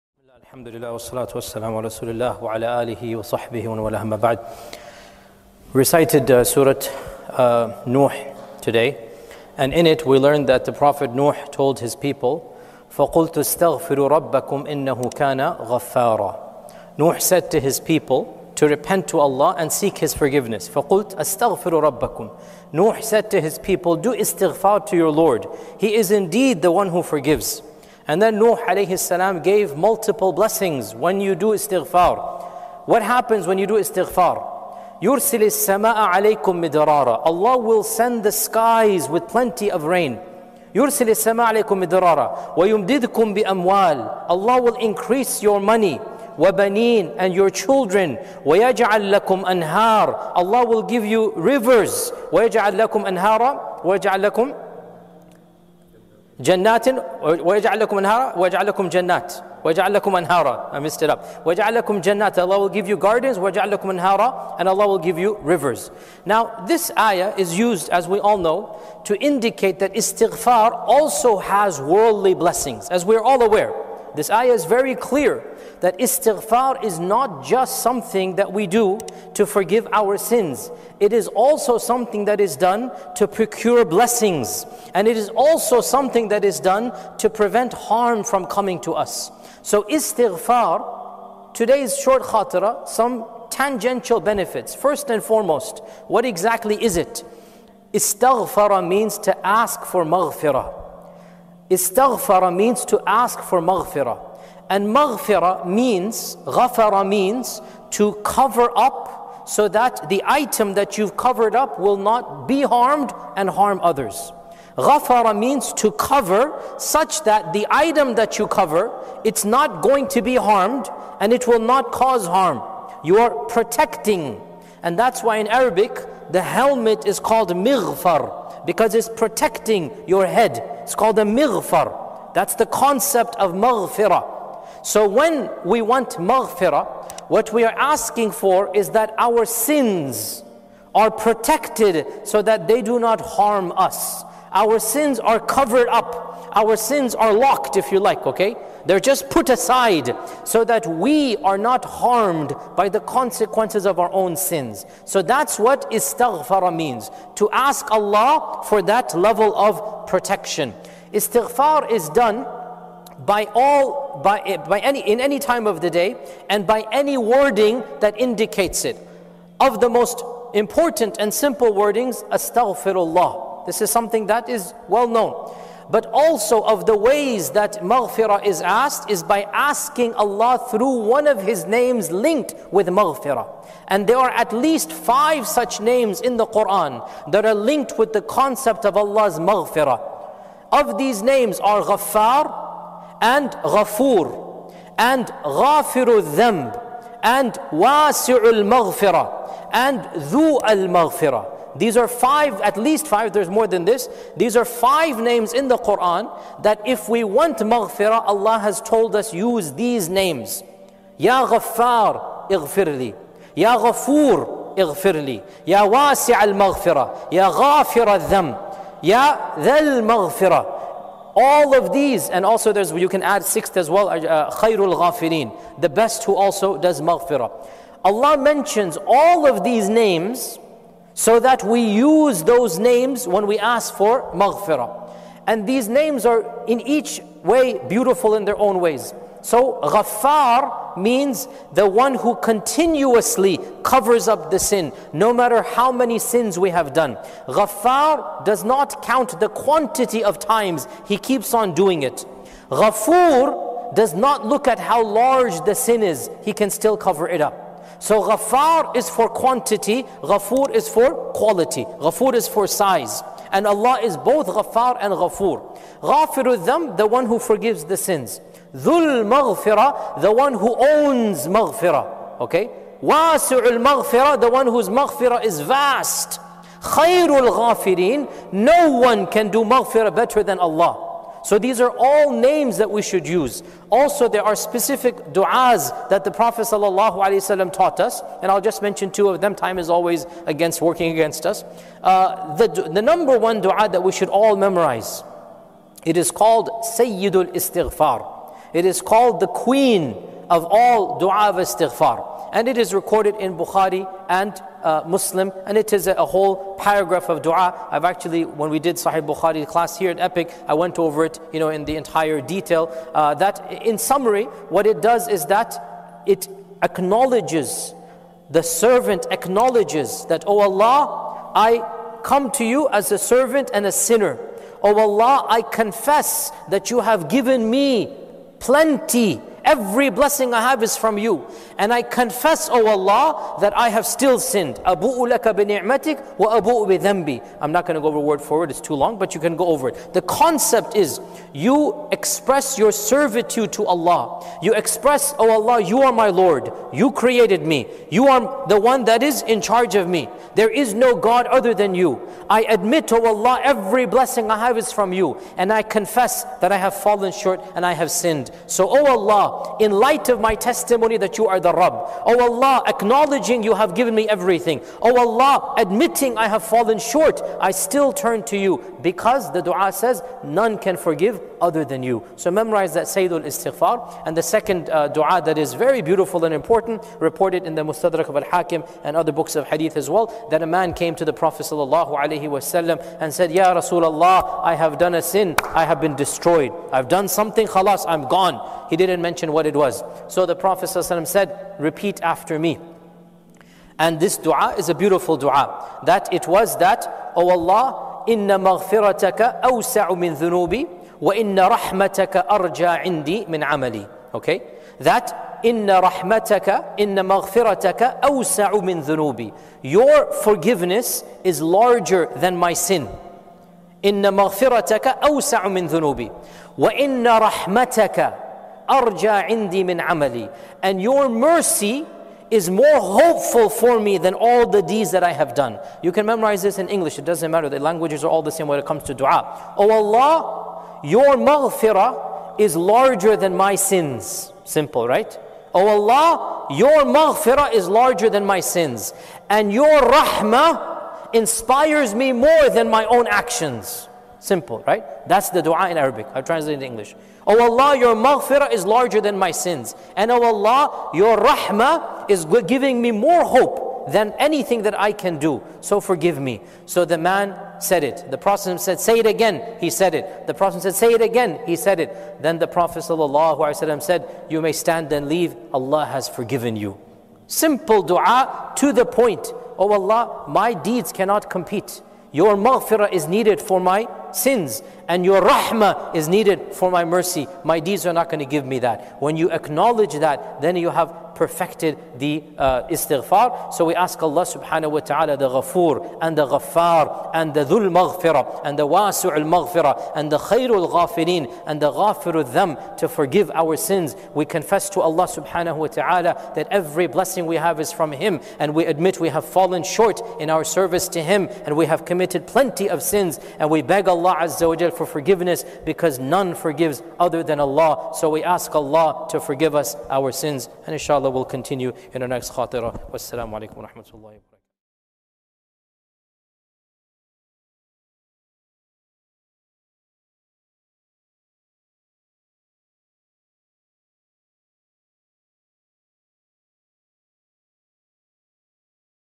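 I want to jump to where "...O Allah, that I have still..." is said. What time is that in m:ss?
5:32.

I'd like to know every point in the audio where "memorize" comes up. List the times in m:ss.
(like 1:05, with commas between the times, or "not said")
4:54, 6:12, 7:06.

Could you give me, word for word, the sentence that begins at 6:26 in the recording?
I've done something, khalas, I'm gone.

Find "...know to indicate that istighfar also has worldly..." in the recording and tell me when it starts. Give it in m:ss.
1:08.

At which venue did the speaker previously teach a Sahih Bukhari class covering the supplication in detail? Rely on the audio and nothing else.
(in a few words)
Epic.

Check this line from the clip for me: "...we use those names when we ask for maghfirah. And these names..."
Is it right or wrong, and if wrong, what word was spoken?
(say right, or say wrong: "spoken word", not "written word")
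right.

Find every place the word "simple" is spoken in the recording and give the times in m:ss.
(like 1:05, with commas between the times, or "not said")
2:51, 7:14, 7:24, 7:47.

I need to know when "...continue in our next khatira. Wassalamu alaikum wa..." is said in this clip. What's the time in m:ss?
8:31.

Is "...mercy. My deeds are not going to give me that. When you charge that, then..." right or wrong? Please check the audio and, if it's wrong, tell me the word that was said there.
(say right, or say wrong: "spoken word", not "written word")
wrong: "acknowledge", not "charge".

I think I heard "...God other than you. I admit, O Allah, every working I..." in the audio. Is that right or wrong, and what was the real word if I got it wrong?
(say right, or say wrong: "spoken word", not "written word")
wrong: "blessing", not "working".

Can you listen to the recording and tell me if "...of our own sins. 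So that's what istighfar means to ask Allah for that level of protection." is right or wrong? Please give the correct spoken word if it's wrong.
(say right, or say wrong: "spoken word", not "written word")
right.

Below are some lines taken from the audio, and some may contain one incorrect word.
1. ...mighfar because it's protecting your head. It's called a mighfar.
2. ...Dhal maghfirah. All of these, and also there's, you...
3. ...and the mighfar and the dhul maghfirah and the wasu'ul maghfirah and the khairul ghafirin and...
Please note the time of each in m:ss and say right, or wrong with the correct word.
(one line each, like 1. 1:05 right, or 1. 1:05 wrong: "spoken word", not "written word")
1. 2:07 right
2. 3:39 right
3. 8:06 wrong: "ghaffar", not "mighfar".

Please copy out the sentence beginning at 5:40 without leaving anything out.
The concept is, you express your servitude to Allah.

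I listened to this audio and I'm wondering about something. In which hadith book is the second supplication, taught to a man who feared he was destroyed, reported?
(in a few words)
Mustadrak of Al-Hakim.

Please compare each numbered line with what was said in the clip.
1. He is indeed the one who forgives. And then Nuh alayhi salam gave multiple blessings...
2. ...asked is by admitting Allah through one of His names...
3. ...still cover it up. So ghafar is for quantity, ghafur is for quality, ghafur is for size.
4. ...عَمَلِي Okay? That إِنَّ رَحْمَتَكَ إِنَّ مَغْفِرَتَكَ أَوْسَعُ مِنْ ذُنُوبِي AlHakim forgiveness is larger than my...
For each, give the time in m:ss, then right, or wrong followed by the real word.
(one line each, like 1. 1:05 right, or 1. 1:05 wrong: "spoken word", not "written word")
1. 0:25 right
2. 2:58 wrong: "asking", not "admitting"
3. 4:16 right
4. 6:43 wrong: "Your", not "AlHakim".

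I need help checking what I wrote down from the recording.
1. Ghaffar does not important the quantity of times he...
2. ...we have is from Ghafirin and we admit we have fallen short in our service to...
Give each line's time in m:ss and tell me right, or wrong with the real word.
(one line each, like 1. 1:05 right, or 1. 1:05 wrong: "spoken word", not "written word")
1. 4:07 wrong: "count", not "important"
2. 8:17 wrong: "Him", not "Ghafirin".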